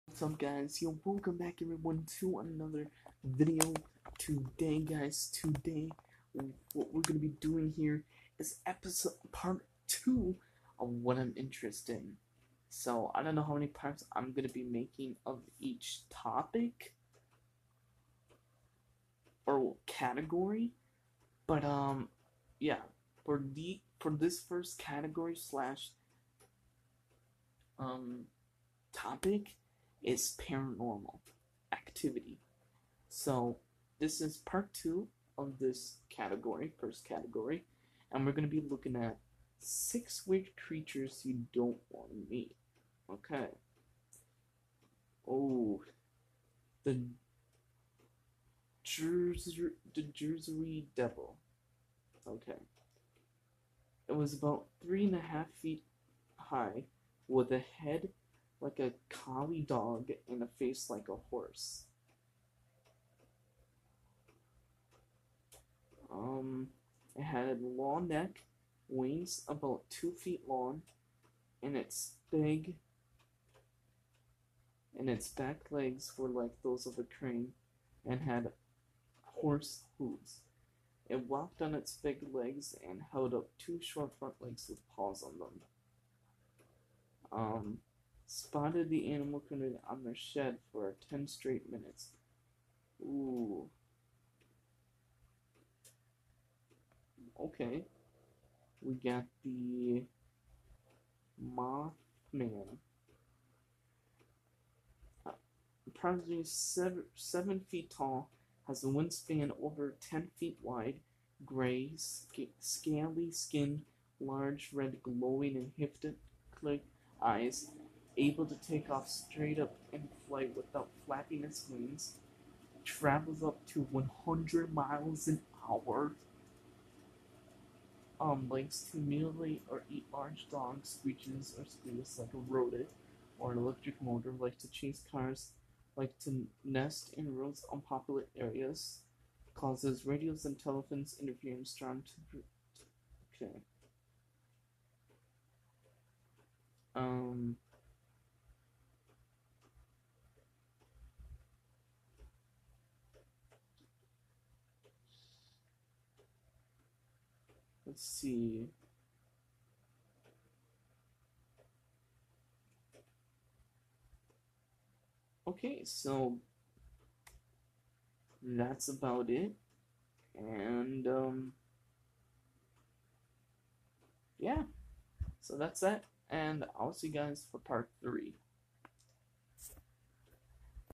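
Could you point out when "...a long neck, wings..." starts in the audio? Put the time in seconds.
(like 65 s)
67 s.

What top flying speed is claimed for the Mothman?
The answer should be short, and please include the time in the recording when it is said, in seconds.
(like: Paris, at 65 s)
100 miles an hour, at 123 s.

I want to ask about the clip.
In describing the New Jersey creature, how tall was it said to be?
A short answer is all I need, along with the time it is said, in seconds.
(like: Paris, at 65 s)
3.5 feet, at 54 s.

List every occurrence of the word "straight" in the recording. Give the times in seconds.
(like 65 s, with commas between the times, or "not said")
91 s, 119 s.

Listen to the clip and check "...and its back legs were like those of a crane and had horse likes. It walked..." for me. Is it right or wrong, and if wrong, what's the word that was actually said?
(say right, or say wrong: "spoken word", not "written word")
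wrong: "hooves", not "likes".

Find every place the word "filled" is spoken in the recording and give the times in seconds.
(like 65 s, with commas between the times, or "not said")
not said.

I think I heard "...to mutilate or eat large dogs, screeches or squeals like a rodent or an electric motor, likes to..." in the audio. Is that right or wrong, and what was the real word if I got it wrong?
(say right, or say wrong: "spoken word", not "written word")
right.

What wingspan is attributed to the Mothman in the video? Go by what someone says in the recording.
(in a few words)
over 10 feet.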